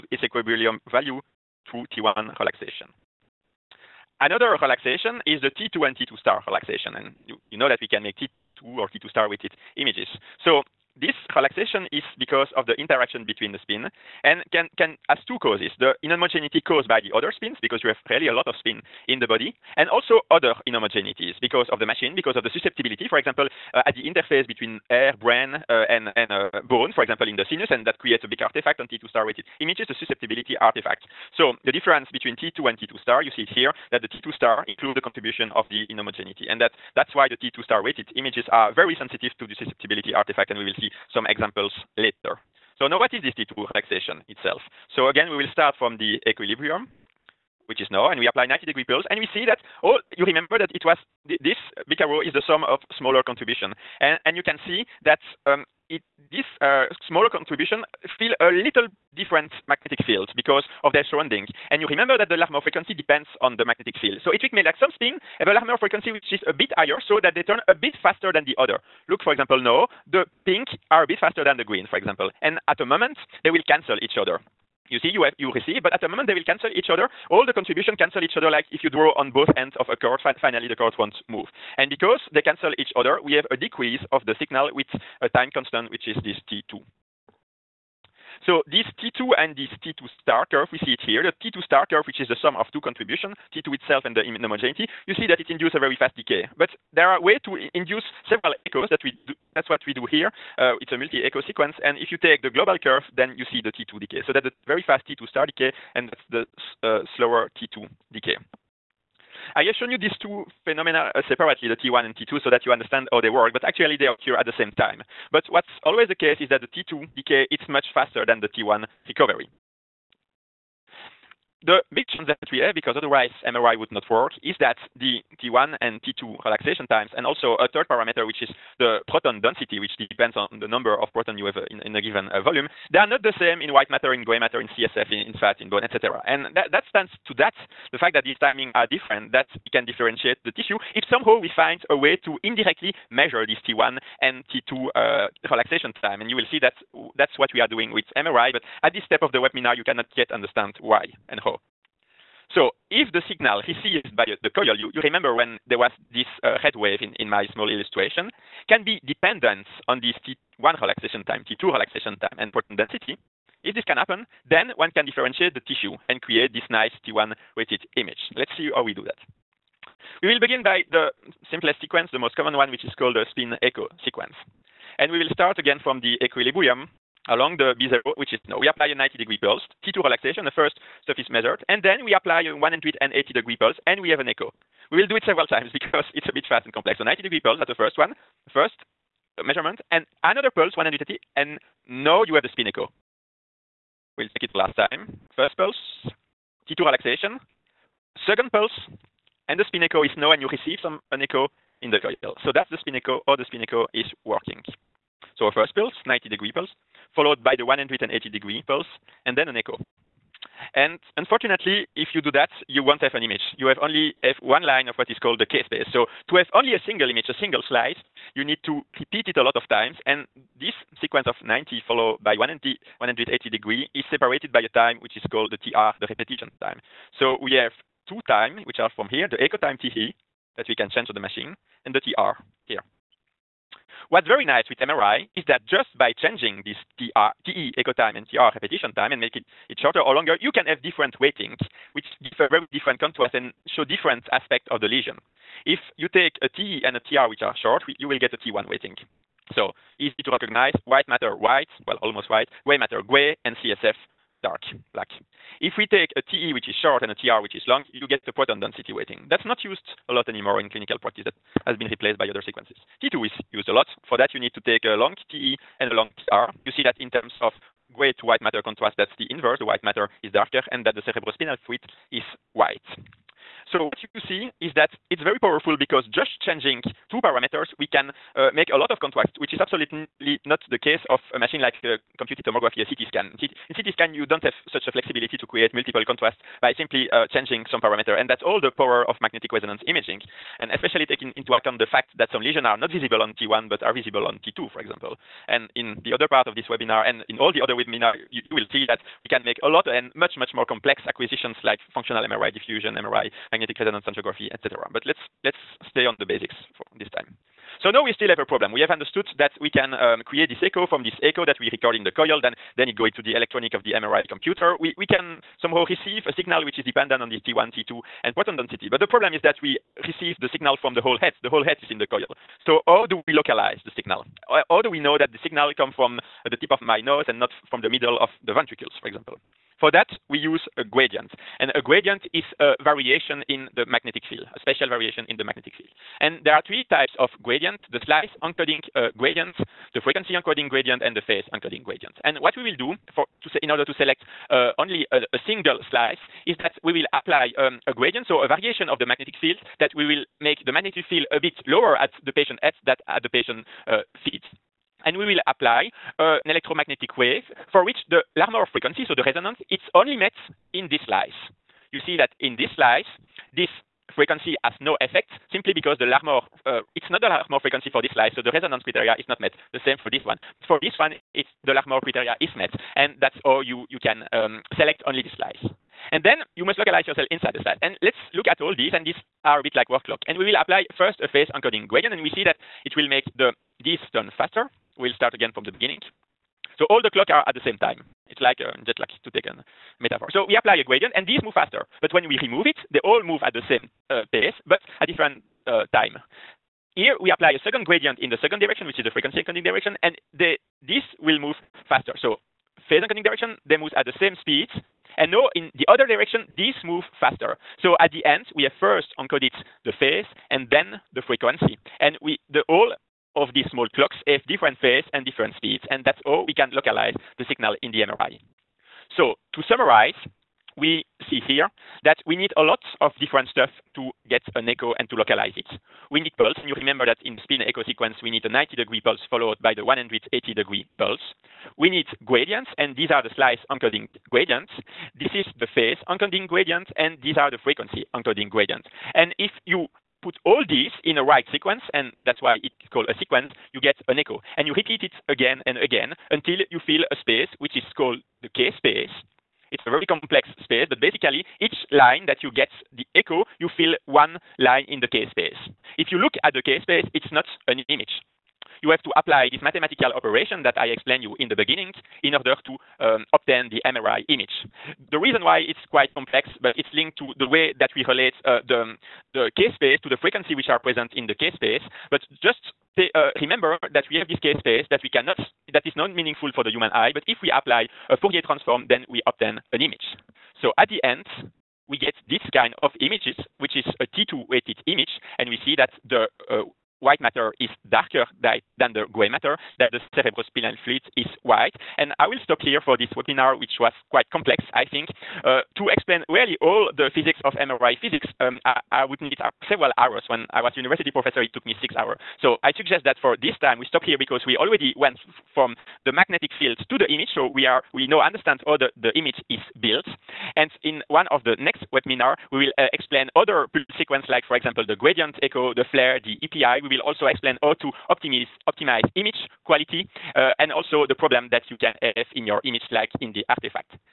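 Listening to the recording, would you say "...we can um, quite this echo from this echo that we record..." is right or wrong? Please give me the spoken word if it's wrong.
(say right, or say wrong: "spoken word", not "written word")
wrong: "create", not "quite".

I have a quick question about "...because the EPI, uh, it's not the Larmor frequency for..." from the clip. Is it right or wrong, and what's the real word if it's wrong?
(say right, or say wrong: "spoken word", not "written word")
wrong: "Larmor", not "EPI".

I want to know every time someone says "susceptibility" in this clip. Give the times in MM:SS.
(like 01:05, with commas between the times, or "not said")
00:22, 00:29, 00:39.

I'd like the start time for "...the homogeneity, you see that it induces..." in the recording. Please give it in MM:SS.
01:34.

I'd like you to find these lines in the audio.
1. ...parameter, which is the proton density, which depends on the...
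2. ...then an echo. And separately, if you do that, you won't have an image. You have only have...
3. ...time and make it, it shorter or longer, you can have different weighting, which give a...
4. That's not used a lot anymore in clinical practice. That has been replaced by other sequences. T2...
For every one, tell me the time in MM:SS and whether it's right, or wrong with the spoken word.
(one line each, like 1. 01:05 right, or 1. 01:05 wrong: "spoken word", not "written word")
1. 02:07 right
2. 03:29 wrong: "unfortunately", not "separately"
3. 03:58 right
4. 04:19 right.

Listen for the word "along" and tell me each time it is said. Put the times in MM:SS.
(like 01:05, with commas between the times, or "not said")
02:57.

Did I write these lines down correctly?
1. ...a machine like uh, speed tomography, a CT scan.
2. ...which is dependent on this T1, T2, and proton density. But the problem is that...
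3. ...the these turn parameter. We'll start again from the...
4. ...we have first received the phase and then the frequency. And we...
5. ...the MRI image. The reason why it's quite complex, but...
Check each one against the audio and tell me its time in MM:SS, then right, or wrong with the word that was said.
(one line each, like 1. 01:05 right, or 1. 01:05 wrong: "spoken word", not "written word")
1. 04:41 wrong: "computed", not "speed"
2. 05:16 right
3. 06:23 wrong: "faster", not "parameter"
4. 06:48 wrong: "encoded", not "received"
5. 07:43 right.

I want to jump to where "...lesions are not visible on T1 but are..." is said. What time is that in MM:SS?
04:52.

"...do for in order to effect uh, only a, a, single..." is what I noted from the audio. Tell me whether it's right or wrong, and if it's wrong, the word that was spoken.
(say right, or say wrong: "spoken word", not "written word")
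wrong: "select", not "effect".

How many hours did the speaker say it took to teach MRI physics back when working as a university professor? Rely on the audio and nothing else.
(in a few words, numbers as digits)
6 hours.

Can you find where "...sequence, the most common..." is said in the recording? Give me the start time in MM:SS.
02:51.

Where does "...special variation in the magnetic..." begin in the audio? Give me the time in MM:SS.
05:34.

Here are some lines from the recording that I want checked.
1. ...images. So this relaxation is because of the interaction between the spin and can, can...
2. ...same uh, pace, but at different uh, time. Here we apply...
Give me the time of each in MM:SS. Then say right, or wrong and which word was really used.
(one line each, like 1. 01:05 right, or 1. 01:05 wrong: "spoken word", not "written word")
1. 00:09 right
2. 06:33 right.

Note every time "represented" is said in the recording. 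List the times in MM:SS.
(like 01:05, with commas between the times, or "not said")
not said.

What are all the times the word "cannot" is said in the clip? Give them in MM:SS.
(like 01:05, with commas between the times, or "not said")
02:29, 07:55.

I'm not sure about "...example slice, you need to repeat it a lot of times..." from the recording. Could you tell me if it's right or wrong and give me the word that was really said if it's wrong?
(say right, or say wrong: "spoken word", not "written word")
wrong: "single", not "example".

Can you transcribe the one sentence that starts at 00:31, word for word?
So the difference between T2 and T2 star, you see it here, that the T2 star includes the contribution of the inhomogeneity.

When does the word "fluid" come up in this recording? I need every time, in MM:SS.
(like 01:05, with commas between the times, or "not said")
04:31, 08:10.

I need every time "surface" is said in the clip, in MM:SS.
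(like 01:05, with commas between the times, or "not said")
03:01.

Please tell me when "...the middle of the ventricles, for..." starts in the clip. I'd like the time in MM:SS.
05:27.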